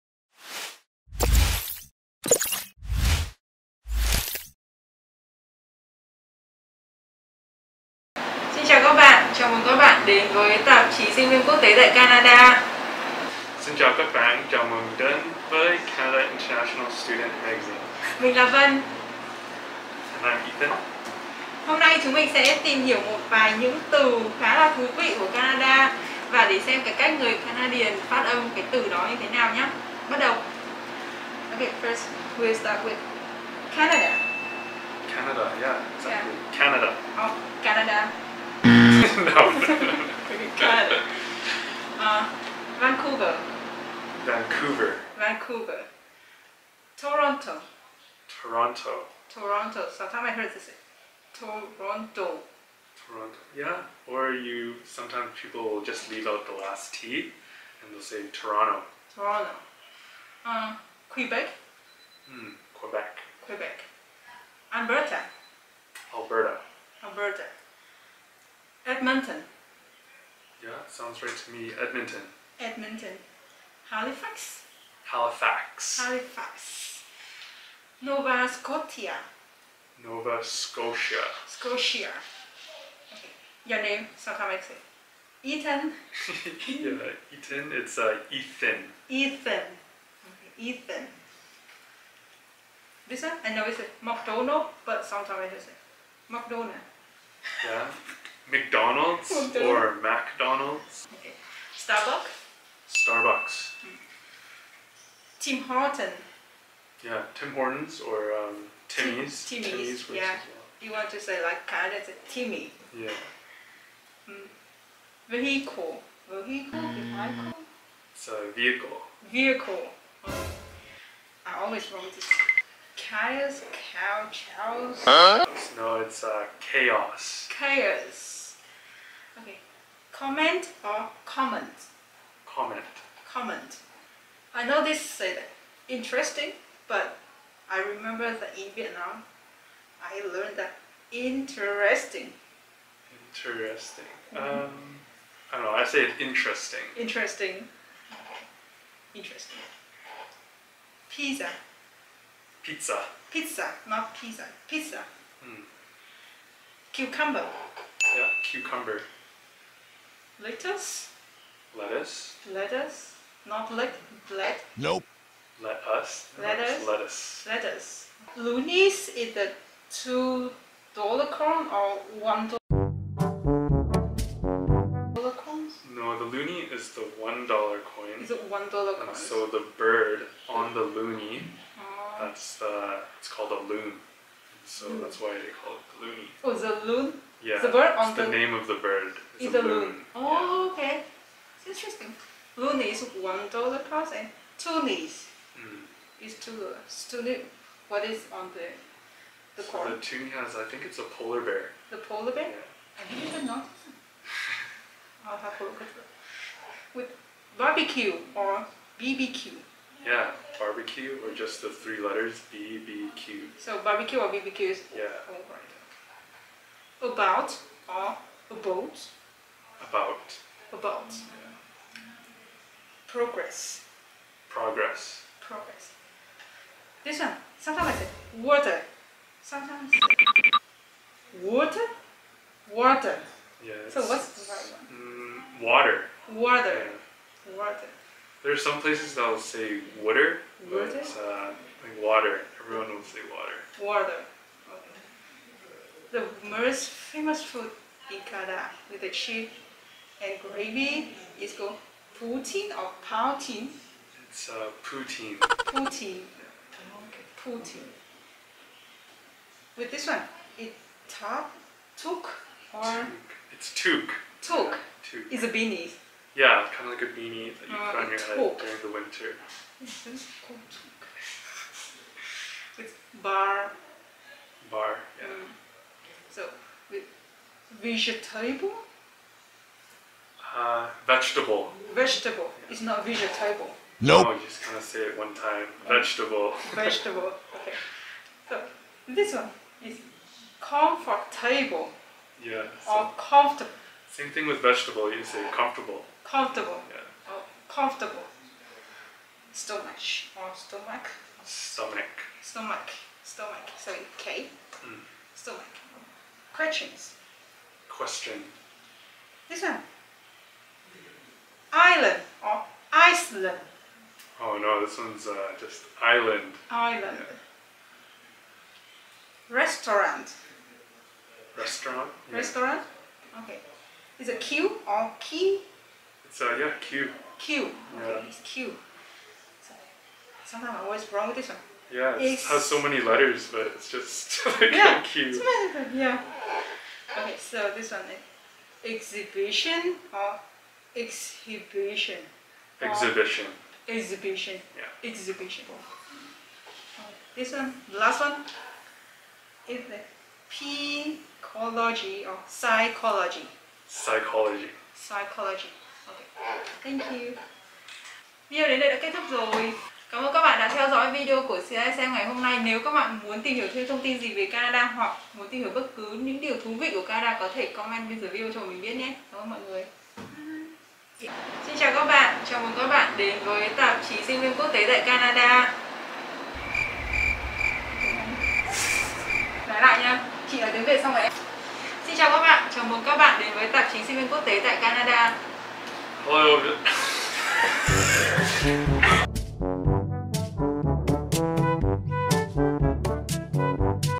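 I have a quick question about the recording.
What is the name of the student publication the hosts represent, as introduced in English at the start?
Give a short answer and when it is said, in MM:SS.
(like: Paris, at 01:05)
Canada International Student Magazine, at 00:15.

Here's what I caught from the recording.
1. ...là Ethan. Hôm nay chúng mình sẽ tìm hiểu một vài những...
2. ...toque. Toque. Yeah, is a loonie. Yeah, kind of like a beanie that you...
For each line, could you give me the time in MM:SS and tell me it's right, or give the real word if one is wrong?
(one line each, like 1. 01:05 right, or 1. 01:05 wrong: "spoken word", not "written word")
1. 00:20 right
2. 04:23 wrong: "beanie", not "loonie".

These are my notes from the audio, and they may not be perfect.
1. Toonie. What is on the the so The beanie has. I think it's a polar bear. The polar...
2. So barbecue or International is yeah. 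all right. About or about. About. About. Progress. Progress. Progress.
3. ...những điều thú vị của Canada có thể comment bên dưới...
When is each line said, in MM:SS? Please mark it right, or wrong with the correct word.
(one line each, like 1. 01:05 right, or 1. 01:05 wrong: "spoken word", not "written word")
1. 03:17 wrong: "toonie", not "beanie"
2. 03:33 wrong: "BBQ", not "International"
3. 06:06 right.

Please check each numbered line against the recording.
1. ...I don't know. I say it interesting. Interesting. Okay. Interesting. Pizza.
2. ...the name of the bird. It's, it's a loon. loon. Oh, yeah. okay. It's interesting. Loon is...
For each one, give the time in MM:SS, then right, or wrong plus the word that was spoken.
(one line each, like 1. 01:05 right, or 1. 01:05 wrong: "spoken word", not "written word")
1. 02:25 right
2. 03:08 right.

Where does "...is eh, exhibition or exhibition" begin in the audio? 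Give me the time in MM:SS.
05:38.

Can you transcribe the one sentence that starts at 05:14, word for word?
Oh no, this one's uh, just island.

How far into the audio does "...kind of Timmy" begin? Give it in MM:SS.
01:51.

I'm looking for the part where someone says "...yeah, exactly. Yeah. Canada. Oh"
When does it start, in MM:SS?
00:35.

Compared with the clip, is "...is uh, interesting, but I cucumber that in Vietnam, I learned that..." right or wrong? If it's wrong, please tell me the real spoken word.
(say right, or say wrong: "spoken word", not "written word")
wrong: "remember", not "cucumber".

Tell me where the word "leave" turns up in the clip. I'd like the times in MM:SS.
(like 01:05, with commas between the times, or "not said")
00:56.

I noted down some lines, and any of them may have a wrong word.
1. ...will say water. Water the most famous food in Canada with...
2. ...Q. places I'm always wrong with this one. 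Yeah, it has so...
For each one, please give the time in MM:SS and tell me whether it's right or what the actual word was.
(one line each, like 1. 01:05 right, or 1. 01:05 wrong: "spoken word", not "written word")
1. 04:02 right
2. 05:28 wrong: "sometimes", not "places".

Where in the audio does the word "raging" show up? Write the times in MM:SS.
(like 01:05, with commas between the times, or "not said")
not said.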